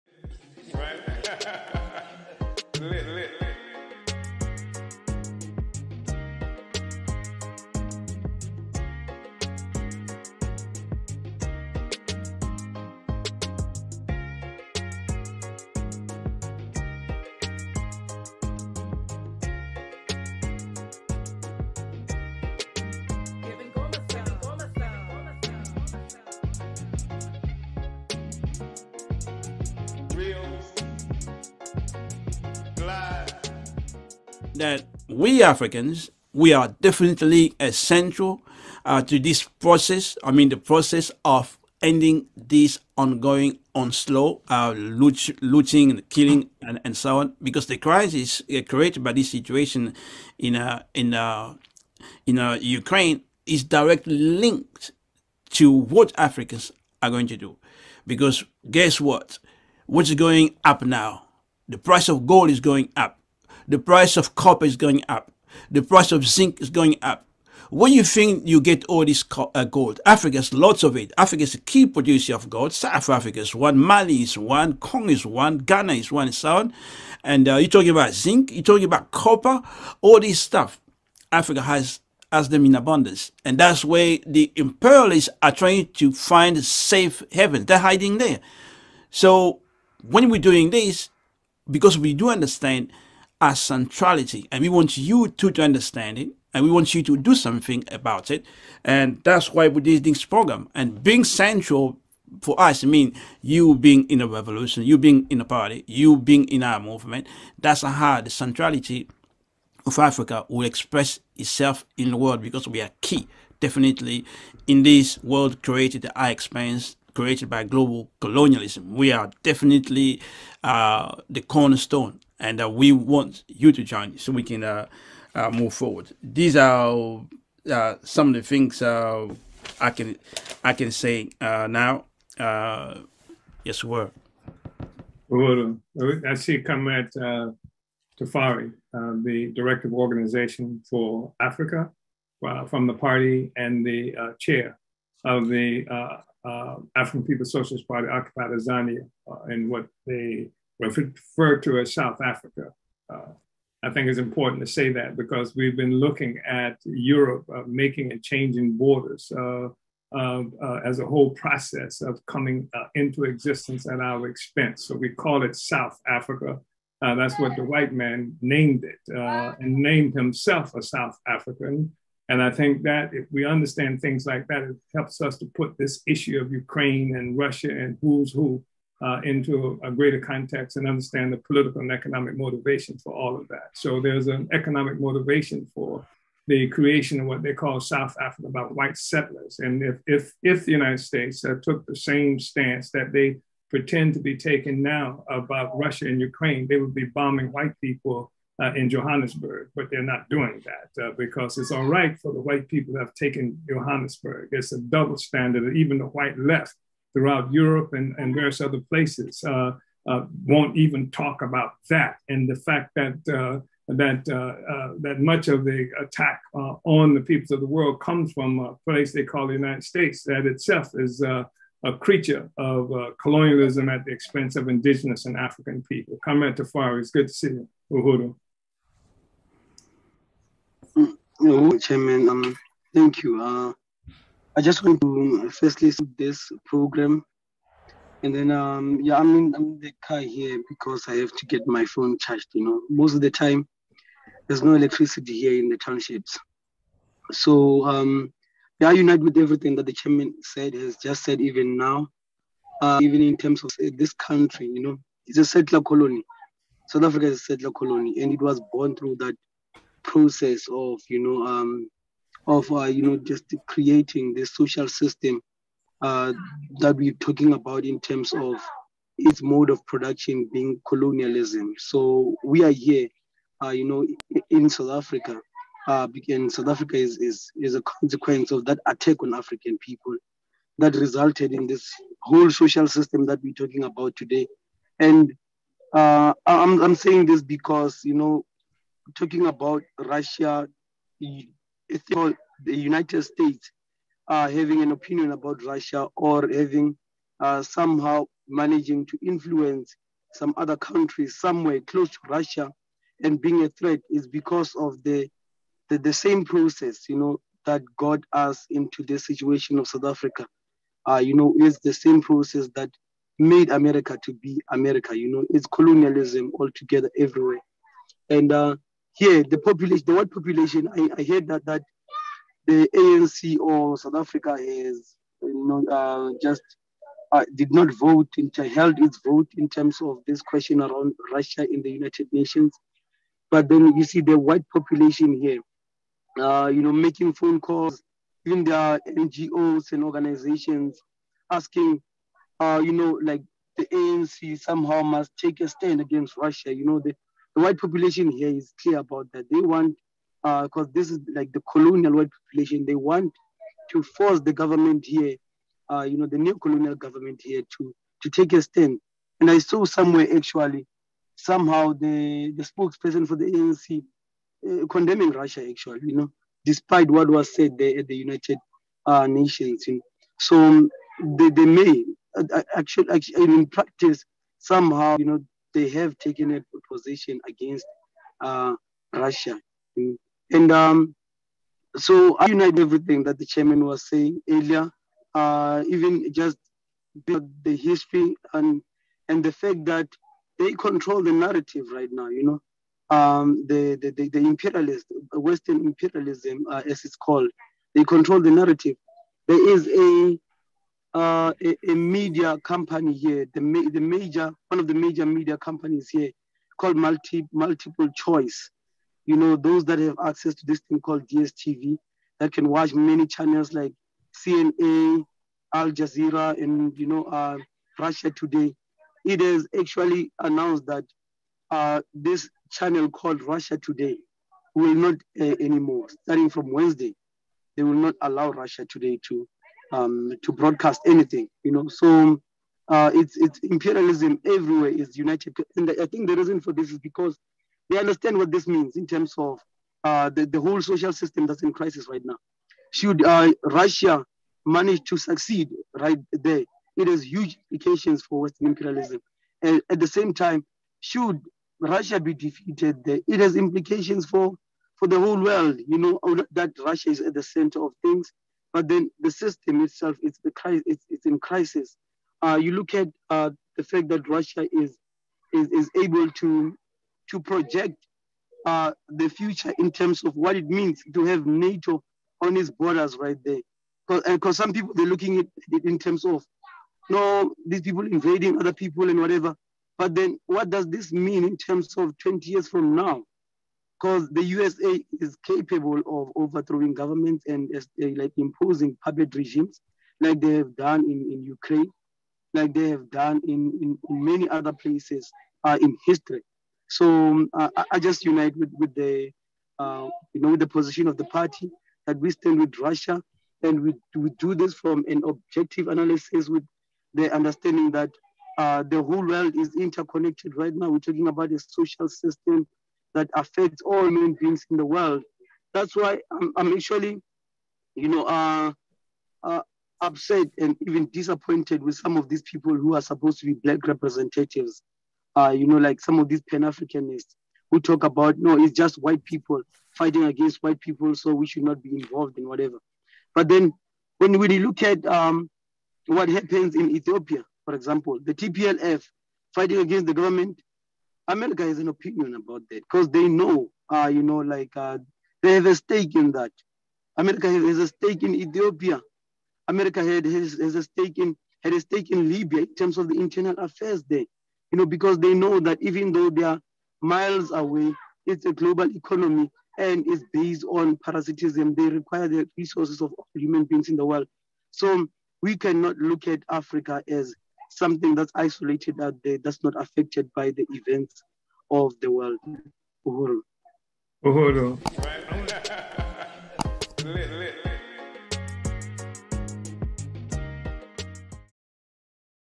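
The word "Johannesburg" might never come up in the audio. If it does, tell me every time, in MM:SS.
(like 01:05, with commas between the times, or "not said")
03:18, 03:23.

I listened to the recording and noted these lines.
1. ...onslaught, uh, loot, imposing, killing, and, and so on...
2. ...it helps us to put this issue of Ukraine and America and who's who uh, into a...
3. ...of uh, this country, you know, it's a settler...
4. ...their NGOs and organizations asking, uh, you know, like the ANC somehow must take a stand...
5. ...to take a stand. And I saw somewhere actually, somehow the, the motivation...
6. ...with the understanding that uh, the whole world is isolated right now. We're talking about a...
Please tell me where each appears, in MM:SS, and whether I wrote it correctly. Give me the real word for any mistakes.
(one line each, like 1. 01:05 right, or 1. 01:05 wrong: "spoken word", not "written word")
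1. 00:43 wrong: "looting", not "imposing"
2. 02:54 wrong: "Russia", not "America"
3. 04:13 right
4. 05:38 right
5. 05:58 wrong: "spokesperson", not "motivation"
6. 08:26 wrong: "interconnected", not "isolated".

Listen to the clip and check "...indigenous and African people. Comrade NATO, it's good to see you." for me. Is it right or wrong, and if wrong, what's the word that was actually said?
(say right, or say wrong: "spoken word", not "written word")
wrong: "Tafari", not "NATO".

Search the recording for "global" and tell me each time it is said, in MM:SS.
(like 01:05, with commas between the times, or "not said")
01:57, 09:18.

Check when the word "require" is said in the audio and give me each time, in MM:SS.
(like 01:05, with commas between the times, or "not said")
09:21.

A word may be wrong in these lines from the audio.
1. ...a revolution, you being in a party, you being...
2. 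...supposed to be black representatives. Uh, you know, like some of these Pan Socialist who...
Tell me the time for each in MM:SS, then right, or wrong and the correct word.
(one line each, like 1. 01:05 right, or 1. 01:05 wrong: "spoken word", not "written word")
1. 01:44 right
2. 08:43 wrong: "Africanists", not "Socialist".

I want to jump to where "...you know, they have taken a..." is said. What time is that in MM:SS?
06:15.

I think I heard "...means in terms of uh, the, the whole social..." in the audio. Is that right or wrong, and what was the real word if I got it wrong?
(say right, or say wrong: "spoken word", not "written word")
right.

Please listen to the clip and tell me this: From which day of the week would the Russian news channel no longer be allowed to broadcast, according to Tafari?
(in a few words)
Wednesday.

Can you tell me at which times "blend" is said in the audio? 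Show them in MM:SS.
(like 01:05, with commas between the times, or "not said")
not said.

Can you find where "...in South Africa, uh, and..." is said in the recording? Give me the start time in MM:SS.
04:34.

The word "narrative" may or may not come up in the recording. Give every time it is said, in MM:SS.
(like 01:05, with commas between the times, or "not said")
06:31, 06:38.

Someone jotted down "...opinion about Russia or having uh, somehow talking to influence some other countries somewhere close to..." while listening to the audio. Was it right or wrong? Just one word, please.
wrong.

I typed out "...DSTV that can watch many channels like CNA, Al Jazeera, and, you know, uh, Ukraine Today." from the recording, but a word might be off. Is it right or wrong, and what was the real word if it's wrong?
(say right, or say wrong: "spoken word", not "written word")
wrong: "Russia", not "Ukraine".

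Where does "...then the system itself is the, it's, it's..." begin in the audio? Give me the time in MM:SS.
07:38.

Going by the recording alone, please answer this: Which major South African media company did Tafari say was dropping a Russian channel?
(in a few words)
Multiple Choice.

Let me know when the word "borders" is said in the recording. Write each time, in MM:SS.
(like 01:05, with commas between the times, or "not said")
02:38, 07:52.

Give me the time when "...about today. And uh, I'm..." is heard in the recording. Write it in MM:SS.
04:43.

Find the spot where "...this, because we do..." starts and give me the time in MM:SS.
01:30.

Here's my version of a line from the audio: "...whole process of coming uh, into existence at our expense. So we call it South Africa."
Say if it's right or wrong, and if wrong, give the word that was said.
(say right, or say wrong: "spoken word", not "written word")
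right.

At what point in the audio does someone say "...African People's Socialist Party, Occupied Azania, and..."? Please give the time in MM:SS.
02:26.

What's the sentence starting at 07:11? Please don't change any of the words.
So uh, it's, it's imperialism everywhere is united.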